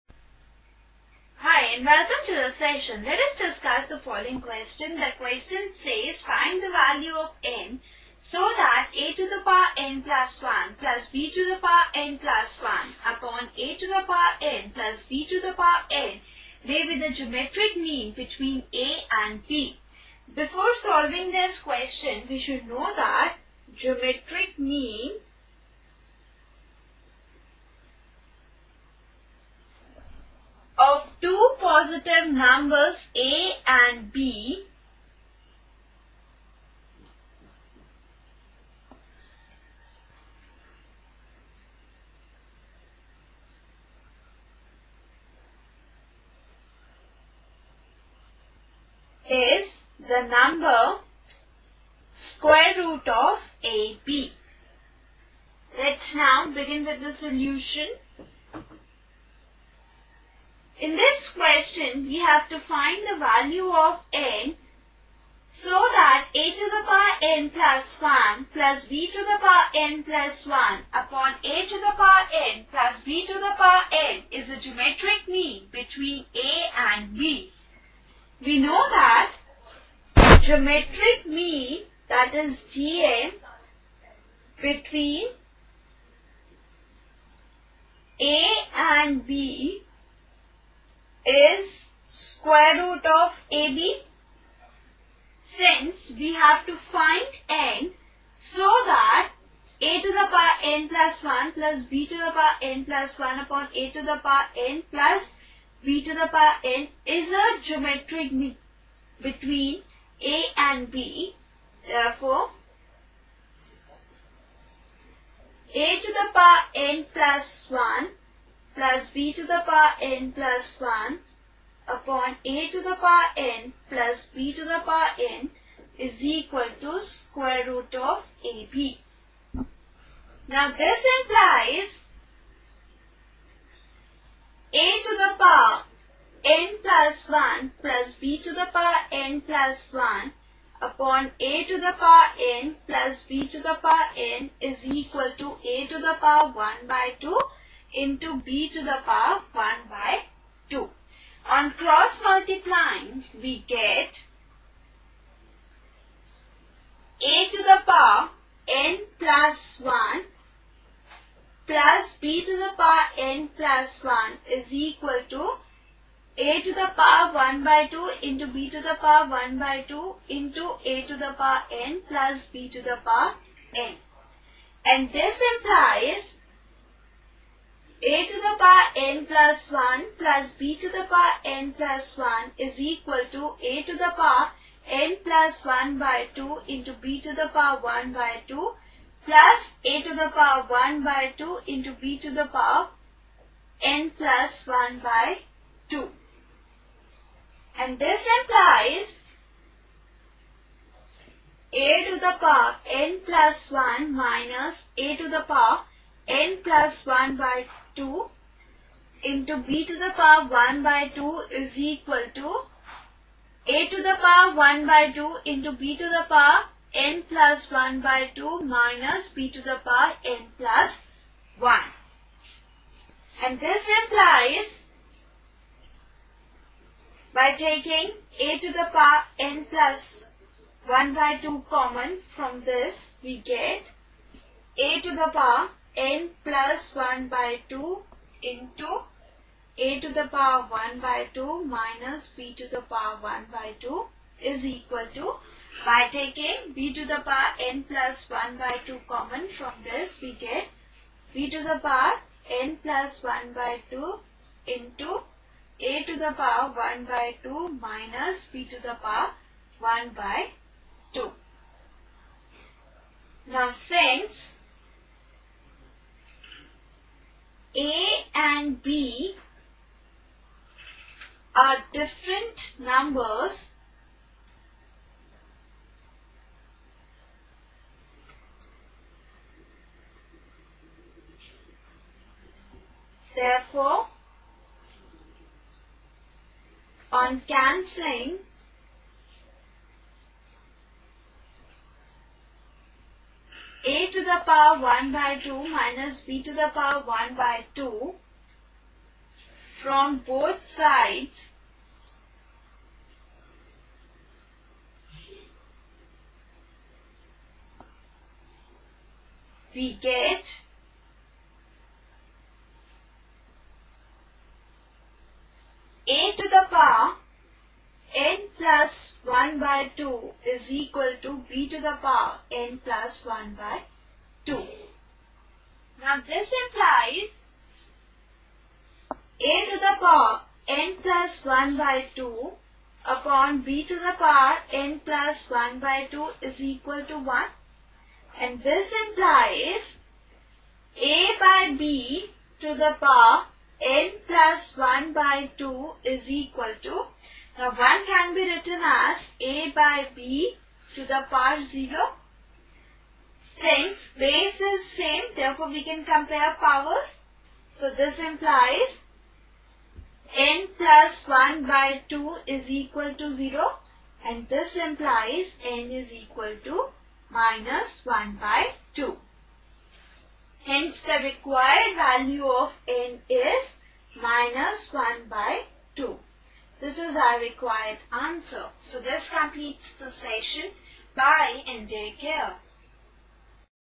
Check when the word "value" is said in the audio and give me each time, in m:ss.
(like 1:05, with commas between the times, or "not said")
0:06, 1:03, 6:11.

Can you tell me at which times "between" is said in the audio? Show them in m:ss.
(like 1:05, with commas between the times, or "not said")
0:18, 1:15, 1:24, 1:49.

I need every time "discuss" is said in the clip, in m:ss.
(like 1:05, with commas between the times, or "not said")
0:03.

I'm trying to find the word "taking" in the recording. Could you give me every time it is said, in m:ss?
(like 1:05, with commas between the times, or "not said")
3:47, 4:06.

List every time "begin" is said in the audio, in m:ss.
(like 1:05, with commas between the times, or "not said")
0:56.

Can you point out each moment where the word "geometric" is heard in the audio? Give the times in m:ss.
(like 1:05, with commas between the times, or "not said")
0:17, 0:23, 1:14, 1:20, 1:47.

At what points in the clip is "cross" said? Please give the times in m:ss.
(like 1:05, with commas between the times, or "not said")
2:31.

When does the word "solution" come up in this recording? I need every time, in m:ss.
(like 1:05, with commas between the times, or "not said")
0:57.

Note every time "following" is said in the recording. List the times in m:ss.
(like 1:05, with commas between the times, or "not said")
0:03.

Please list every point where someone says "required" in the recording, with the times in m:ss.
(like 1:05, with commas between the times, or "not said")
6:11, 6:17.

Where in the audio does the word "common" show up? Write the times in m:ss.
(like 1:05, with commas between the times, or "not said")
3:51, 4:09.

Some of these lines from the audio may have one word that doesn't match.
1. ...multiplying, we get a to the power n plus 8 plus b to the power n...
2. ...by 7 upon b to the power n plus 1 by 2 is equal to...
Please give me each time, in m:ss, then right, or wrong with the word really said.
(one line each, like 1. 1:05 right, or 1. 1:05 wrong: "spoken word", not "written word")
1. 2:32 wrong: "1", not "8"
2. 5:31 wrong: "2", not "7".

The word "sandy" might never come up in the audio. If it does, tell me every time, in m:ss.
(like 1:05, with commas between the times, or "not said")
not said.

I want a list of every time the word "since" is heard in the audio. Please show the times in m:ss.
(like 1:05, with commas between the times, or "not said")
1:35, 4:23, 5:53.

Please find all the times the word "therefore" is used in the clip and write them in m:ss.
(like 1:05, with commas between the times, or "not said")
1:51, 4:43, 5:55.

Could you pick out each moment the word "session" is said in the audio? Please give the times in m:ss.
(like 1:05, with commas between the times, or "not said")
0:02, 6:20.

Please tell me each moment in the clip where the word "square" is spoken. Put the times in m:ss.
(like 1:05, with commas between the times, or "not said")
0:52, 1:32, 2:07.